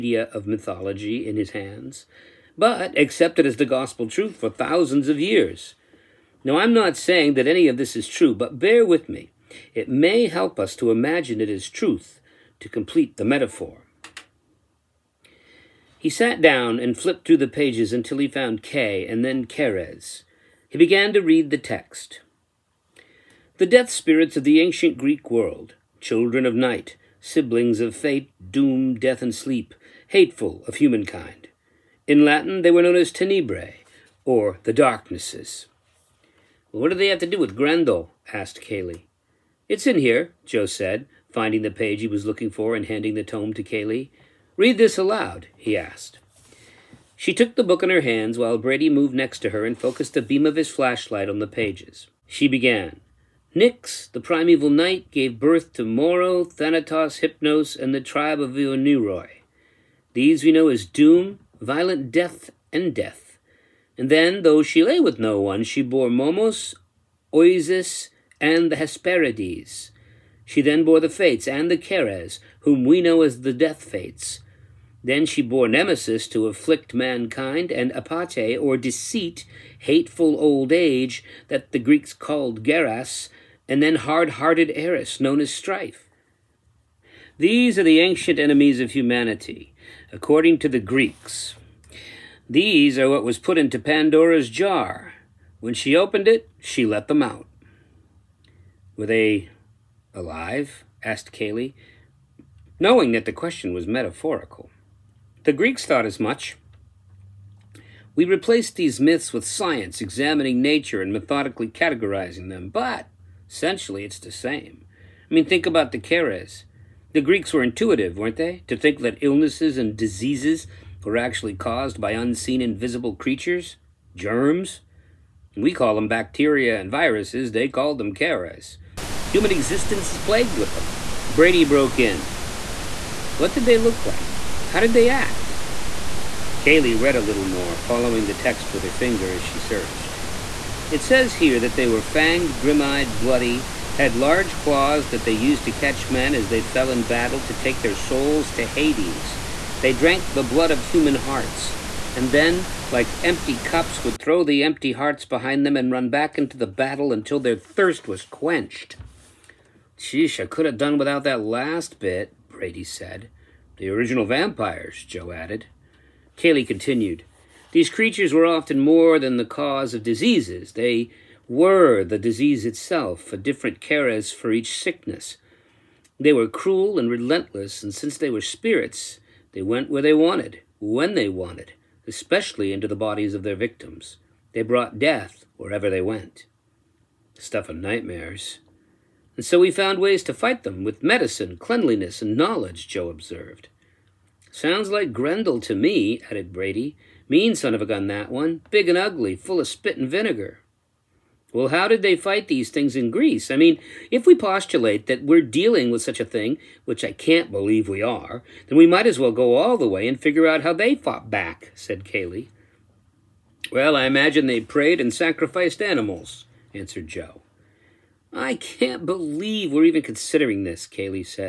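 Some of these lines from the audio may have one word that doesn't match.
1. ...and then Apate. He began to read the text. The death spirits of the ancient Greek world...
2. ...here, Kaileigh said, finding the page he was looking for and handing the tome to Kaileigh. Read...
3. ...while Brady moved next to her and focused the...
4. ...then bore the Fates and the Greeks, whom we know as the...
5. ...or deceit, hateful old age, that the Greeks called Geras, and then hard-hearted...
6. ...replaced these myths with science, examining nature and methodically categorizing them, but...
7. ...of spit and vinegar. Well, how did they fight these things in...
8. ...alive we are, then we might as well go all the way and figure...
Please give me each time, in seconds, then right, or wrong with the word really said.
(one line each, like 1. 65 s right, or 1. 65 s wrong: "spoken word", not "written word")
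1. 19 s wrong: "Keres", not "Apate"
2. 39 s wrong: "Joe", not "Kaileigh"
3. 48 s right
4. 70 s wrong: "Keres", not "Greeks"
5. 78 s right
6. 108 s right
7. 199 s right
8. 207 s wrong: "believe", not "alive".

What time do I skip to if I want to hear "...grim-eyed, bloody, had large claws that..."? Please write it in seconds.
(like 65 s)
142 s.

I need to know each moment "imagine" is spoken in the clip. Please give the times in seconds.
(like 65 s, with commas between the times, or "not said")
10 s, 214 s.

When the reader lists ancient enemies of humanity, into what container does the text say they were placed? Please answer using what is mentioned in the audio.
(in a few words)
Pandora's jar.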